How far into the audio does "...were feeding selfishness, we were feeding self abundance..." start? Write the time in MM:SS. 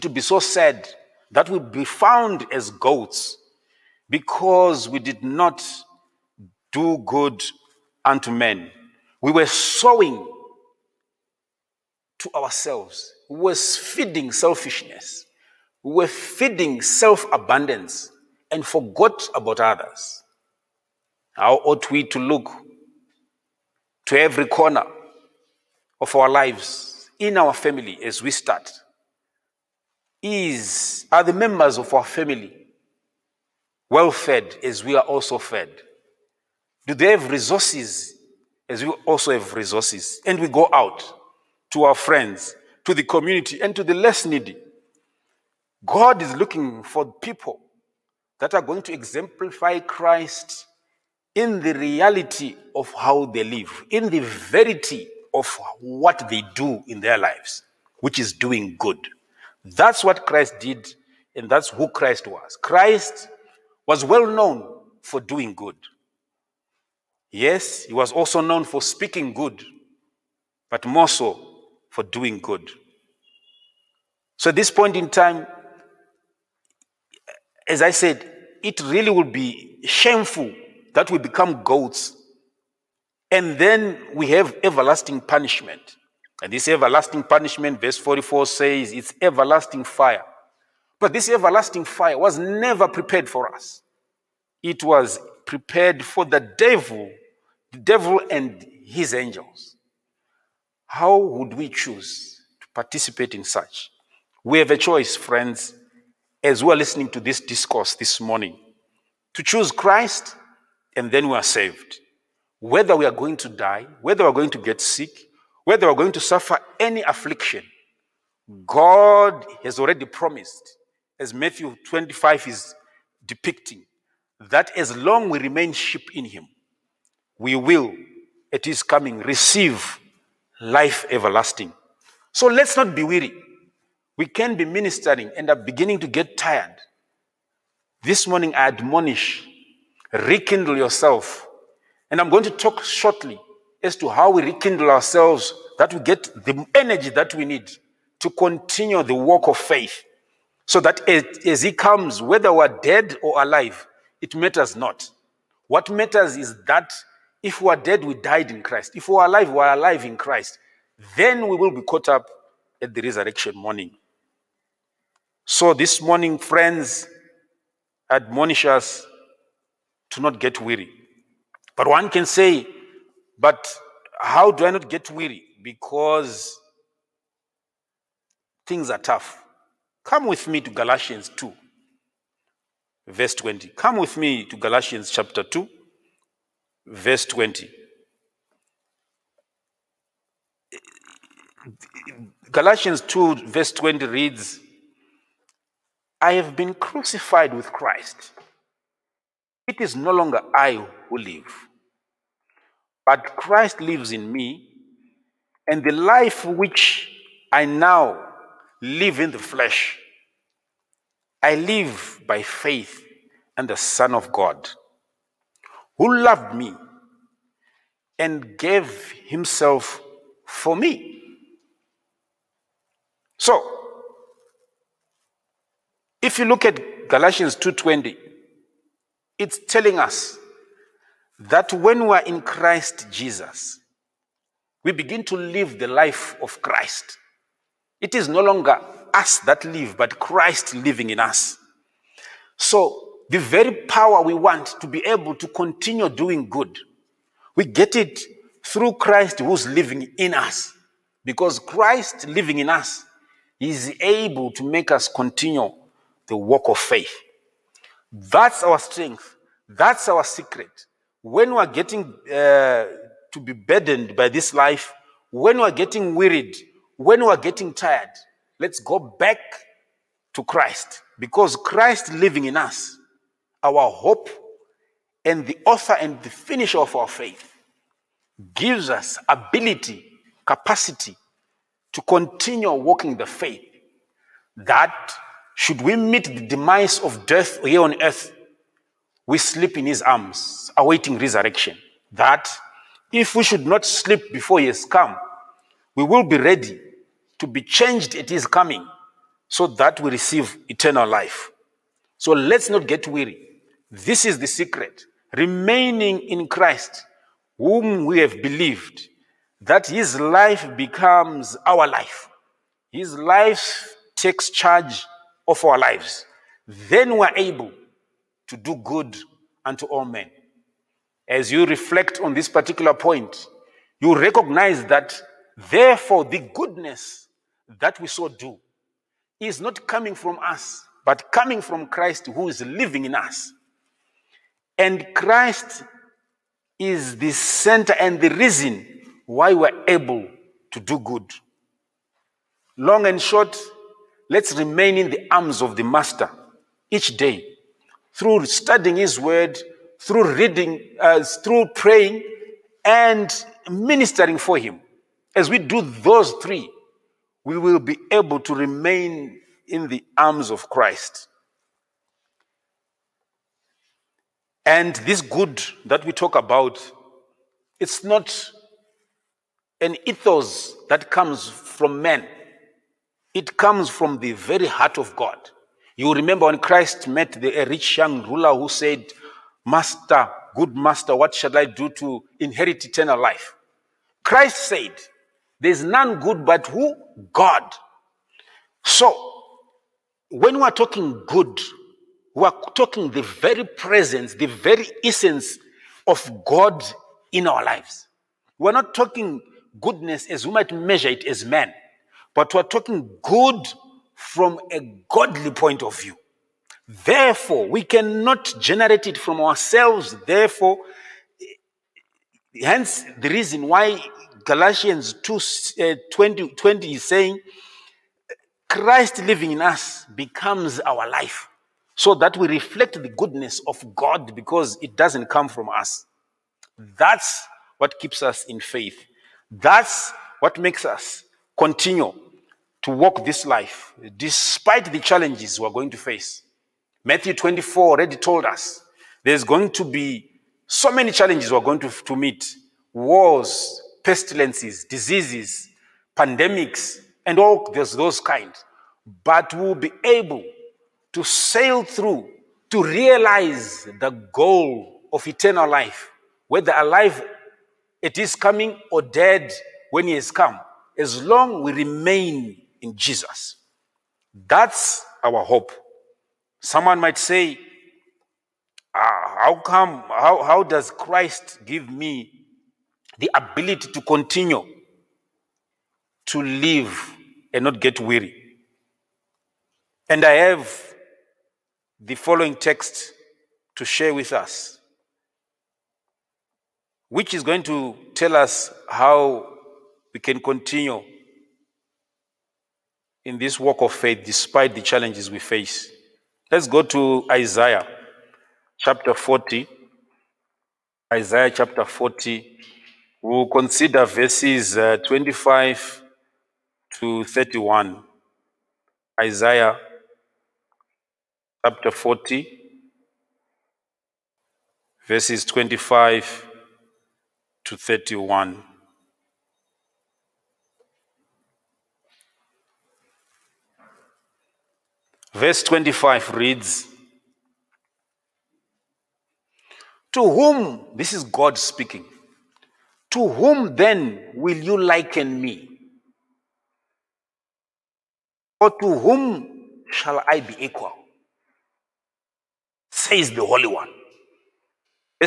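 00:13.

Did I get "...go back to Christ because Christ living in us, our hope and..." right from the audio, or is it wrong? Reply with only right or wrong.
right.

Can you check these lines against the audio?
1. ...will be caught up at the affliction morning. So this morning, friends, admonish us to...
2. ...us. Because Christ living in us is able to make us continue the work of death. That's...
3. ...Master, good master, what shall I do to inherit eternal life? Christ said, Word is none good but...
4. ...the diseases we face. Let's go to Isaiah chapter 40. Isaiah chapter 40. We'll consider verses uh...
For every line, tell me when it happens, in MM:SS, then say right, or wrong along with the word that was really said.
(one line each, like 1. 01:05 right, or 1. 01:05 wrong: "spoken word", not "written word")
1. 02:41 wrong: "resurrection", not "affliction"
2. 04:10 wrong: "faith", not "death"
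3. 06:19 wrong: "There", not "Word"
4. 08:14 wrong: "challenges", not "diseases".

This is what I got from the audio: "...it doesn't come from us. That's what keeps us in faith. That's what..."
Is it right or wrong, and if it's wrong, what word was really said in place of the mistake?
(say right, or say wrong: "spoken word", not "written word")
right.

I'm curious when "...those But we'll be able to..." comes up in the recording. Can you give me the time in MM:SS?
07:27.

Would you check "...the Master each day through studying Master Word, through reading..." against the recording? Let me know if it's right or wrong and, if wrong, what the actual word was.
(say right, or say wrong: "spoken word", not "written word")
wrong: "His", not "Master".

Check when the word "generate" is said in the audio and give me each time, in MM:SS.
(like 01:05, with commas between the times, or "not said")
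06:48.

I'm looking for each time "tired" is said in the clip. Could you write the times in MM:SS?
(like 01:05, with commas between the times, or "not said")
02:16, 04:27.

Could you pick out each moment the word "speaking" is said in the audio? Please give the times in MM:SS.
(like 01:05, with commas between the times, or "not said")
01:08, 08:51.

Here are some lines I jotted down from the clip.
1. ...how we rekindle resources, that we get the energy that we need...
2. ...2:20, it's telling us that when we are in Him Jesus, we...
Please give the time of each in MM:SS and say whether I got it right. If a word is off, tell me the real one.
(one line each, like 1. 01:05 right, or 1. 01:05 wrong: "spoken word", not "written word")
1. 02:24 wrong: "ourselves", not "resources"
2. 03:47 wrong: "Christ", not "Him".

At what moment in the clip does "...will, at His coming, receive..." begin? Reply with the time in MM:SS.
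02:07.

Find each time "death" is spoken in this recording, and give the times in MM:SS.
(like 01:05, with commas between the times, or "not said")
04:47.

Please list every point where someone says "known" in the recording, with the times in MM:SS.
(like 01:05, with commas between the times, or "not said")
01:04, 01:08.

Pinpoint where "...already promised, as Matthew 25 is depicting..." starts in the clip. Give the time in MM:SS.
01:59.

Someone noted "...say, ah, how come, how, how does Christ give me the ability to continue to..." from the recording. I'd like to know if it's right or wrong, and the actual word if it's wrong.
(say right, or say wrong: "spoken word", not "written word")
right.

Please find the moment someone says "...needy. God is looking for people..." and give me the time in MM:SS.
00:44.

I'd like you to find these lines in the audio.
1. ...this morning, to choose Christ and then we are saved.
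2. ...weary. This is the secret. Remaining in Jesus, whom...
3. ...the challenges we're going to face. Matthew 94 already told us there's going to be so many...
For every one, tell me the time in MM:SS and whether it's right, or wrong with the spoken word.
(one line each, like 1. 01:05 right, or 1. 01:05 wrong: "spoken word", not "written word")
1. 01:47 right
2. 05:03 wrong: "Christ", not "Jesus"
3. 07:14 wrong: "24", not "94".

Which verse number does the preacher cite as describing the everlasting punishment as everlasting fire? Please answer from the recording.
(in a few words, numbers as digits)
44.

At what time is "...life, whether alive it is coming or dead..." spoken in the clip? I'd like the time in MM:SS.
07:35.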